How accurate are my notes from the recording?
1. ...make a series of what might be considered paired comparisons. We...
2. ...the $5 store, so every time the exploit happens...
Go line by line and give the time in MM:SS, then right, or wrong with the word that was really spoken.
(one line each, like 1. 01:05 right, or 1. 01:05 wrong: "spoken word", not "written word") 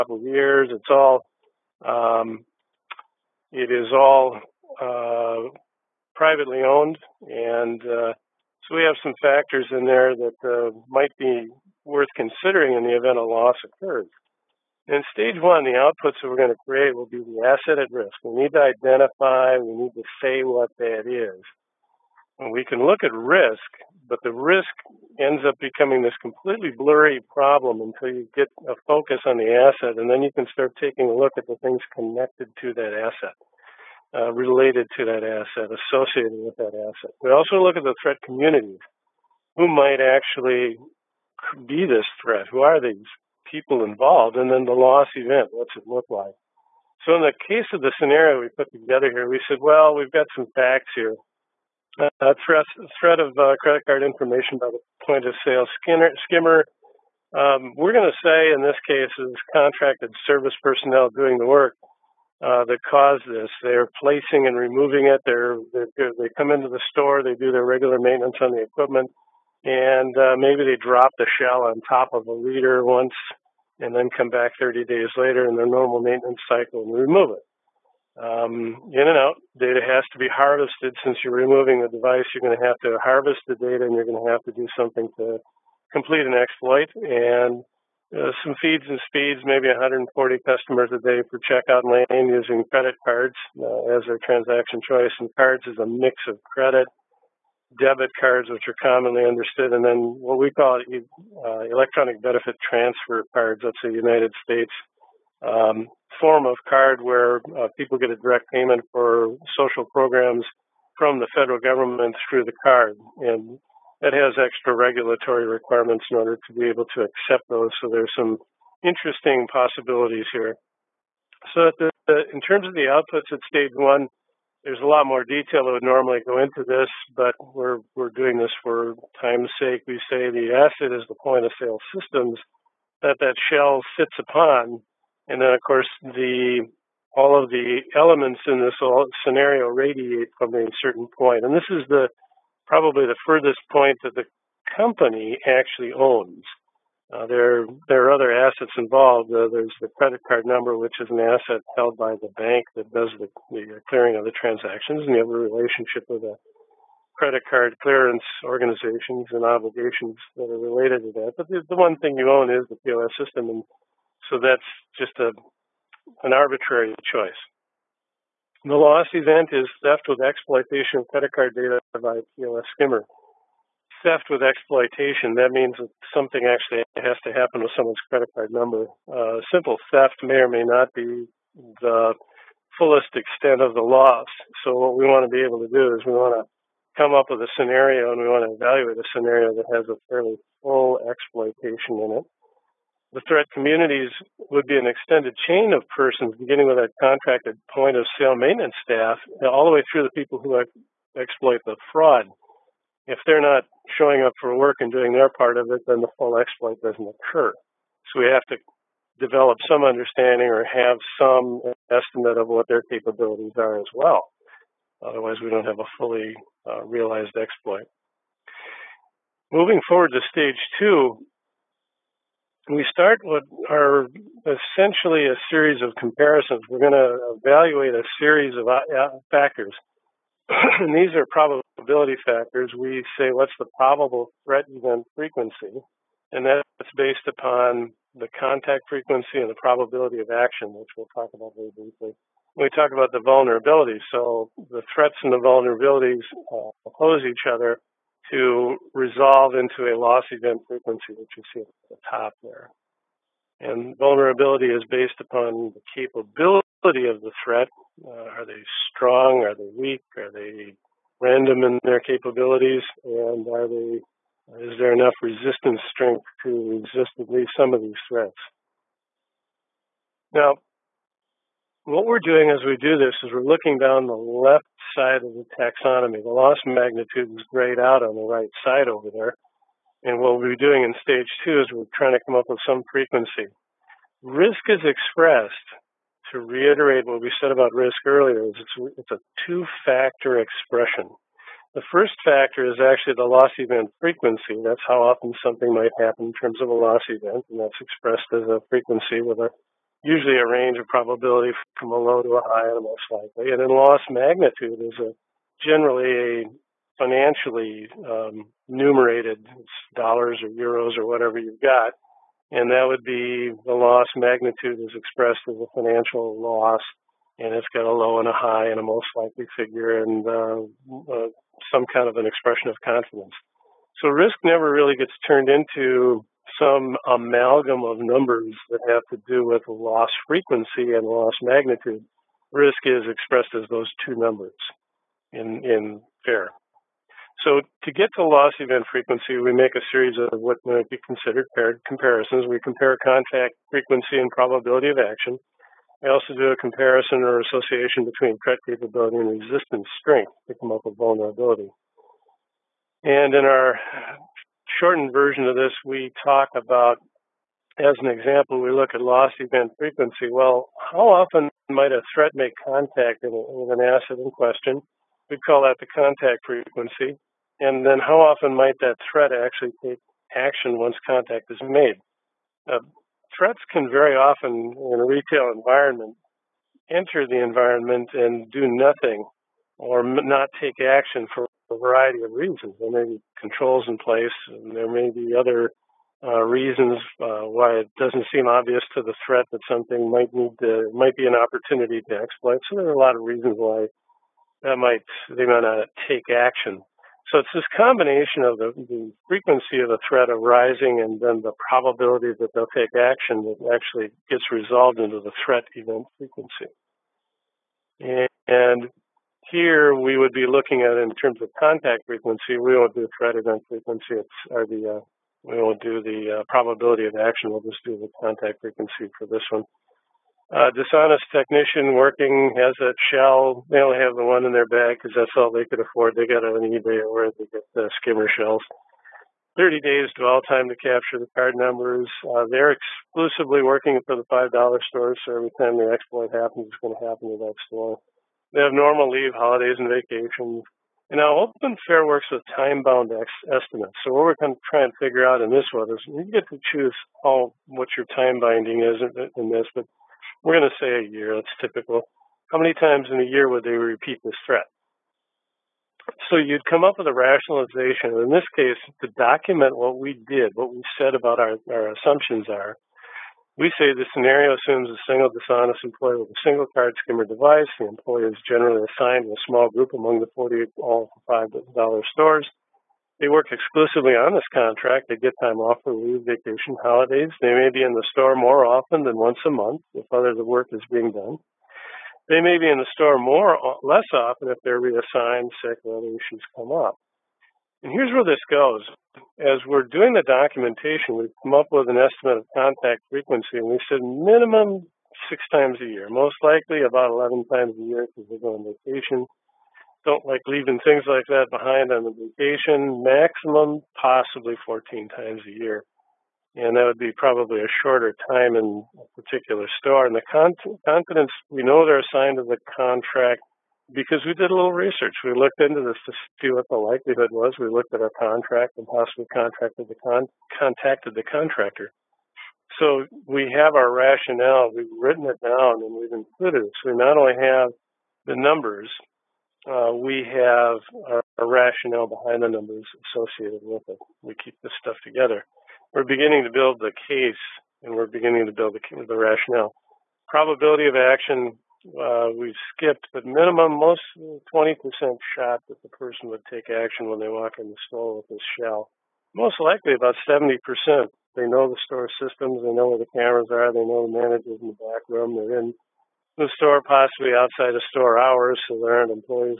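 1. 05:39 right
2. 07:14 right.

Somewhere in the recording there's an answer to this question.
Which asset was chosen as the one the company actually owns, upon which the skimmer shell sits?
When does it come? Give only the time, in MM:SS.
02:11.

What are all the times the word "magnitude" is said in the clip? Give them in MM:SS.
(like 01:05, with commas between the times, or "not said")
04:36, 05:04, 05:14, 05:31.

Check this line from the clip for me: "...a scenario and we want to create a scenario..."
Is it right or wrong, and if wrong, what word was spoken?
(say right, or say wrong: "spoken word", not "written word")
wrong: "evaluate", not "create".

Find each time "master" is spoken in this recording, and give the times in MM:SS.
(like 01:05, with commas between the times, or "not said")
not said.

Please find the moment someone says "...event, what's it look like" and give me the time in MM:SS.
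00:45.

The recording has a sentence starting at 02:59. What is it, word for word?
Uh, simple theft may or may not be the fullest extent of the loss.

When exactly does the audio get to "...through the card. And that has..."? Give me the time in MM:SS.
01:52.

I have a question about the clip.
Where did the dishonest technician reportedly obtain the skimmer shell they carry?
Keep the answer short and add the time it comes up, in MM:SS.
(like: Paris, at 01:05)
eBay, at 07:06.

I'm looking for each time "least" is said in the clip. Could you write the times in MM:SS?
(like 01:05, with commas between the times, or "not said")
04:27.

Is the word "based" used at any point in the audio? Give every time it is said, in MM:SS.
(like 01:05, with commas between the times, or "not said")
03:56, 04:14.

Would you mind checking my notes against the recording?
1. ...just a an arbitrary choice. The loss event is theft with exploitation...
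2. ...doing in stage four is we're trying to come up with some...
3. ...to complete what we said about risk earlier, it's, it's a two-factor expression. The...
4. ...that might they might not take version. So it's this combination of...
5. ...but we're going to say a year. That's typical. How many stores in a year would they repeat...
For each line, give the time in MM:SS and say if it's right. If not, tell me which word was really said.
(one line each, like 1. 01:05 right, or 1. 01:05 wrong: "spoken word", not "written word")
1. 02:44 right
2. 04:40 wrong: "two", not "four"
3. 04:46 wrong: "reiterate", not "complete"
4. 06:34 wrong: "action", not "version"
5. 07:29 wrong: "times", not "stores".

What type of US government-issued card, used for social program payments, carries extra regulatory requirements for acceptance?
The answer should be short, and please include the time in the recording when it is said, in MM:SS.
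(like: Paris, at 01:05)
electronic benefit transfer cards, at 01:41.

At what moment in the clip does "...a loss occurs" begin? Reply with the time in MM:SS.
00:13.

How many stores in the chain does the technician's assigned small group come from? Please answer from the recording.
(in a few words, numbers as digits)
40.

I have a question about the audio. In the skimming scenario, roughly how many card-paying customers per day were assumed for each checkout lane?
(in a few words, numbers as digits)
140.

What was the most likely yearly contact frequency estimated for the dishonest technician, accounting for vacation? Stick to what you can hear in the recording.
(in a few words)
11 times a year.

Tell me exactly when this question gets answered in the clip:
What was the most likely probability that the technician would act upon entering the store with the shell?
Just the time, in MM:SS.
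09:10.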